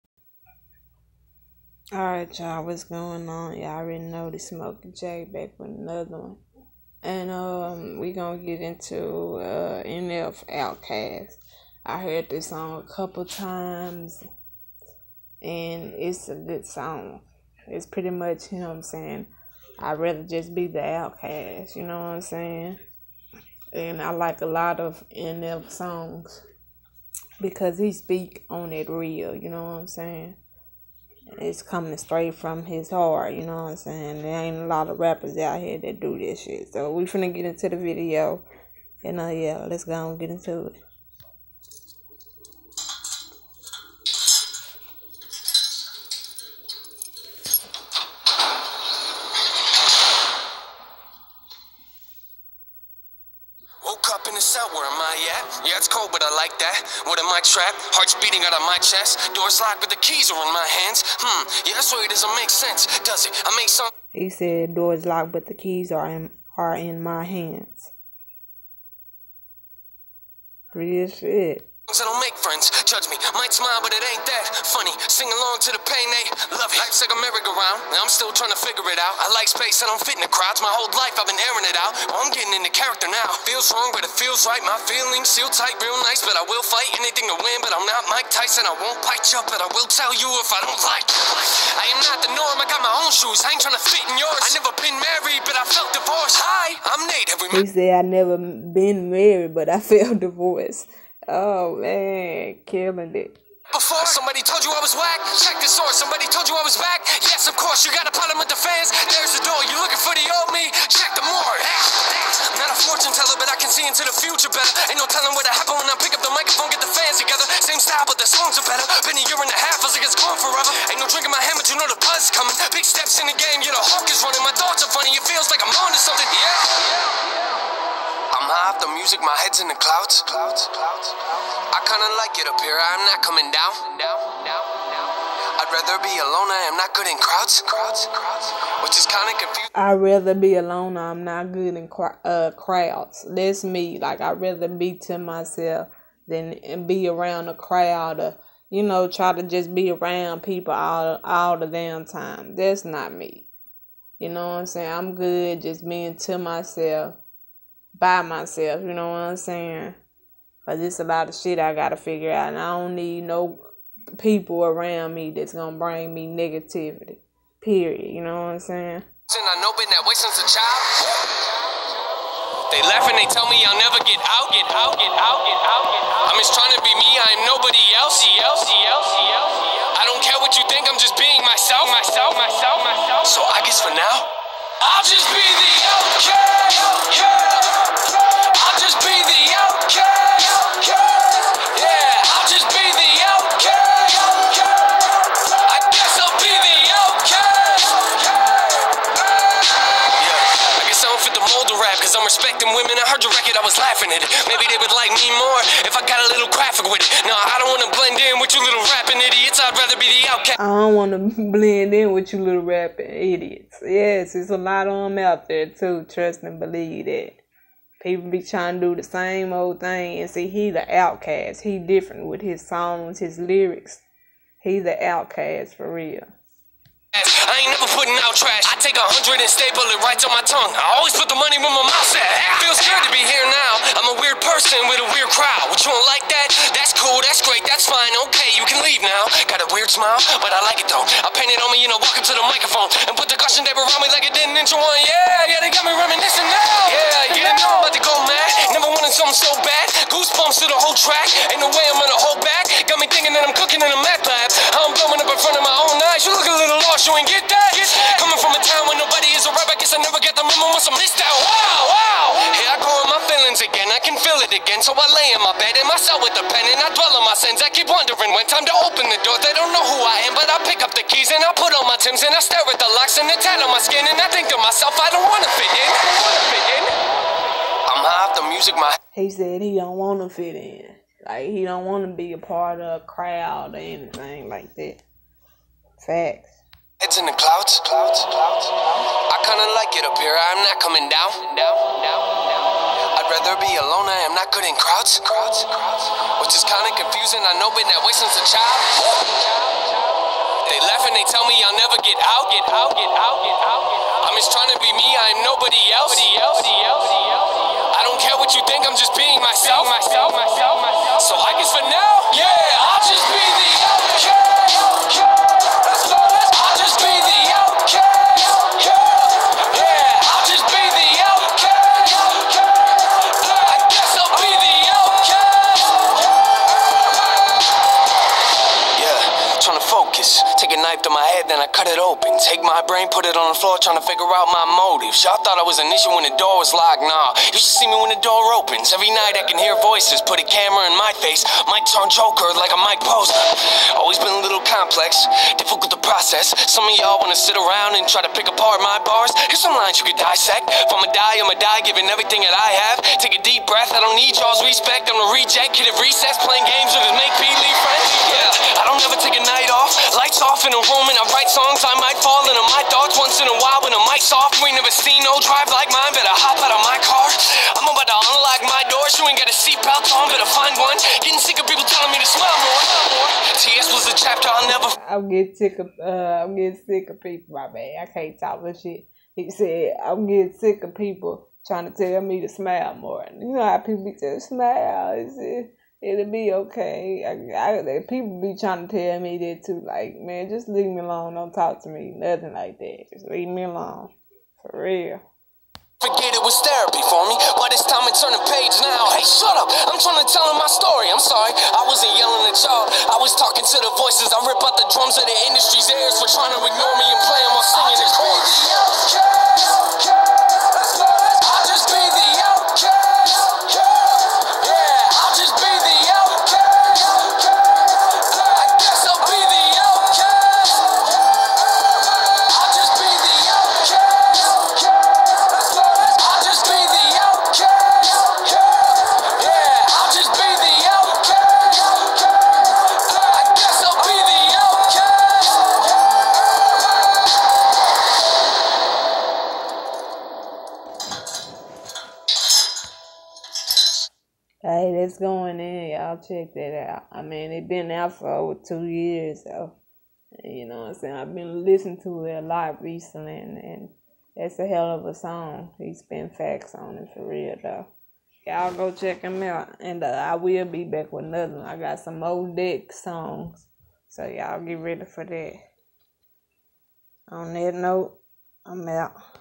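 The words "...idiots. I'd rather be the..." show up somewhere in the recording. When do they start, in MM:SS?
03:29.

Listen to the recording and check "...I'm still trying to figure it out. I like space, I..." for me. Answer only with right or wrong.
right.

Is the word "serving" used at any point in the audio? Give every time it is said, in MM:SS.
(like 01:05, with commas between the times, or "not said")
not said.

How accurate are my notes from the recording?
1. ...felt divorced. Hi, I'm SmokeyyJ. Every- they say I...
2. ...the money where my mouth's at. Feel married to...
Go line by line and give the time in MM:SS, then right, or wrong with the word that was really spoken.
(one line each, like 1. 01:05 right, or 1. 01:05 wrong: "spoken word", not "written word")
1. 01:35 wrong: "Nate", not "SmokeyyJ"
2. 03:51 wrong: "scared", not "married".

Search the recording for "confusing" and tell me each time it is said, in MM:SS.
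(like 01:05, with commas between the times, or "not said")
02:19, 04:56.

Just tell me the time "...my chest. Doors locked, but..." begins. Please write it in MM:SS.
00:58.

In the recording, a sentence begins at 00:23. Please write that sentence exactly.
And I like a lot of NF songs because he speak on it real, you know what I'm saying?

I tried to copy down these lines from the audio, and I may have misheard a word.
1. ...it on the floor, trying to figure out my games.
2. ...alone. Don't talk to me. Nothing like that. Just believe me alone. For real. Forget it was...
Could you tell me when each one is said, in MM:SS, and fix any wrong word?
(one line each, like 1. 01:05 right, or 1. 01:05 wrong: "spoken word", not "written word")
1. 05:33 wrong: "motives", not "games"
2. 06:31 wrong: "leave", not "believe".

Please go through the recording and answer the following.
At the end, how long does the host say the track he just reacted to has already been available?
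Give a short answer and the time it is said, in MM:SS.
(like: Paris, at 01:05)
over 2 years, at 07:28.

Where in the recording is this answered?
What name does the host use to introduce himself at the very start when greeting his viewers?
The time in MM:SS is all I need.
00:04.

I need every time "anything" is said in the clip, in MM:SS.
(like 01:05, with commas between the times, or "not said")
01:26, 04:43.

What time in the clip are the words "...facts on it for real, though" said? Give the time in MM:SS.
07:36.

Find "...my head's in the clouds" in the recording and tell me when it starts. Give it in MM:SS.
02:09.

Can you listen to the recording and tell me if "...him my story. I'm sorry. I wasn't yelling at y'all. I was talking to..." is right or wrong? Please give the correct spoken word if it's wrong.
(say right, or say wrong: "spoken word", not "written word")
right.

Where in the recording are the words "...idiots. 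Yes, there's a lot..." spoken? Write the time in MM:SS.
03:33.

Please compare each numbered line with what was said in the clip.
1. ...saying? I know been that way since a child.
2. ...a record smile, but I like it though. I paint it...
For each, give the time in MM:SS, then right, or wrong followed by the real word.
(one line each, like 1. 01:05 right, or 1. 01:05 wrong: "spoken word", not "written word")
1. 02:48 right
2. 03:59 wrong: "weird", not "record".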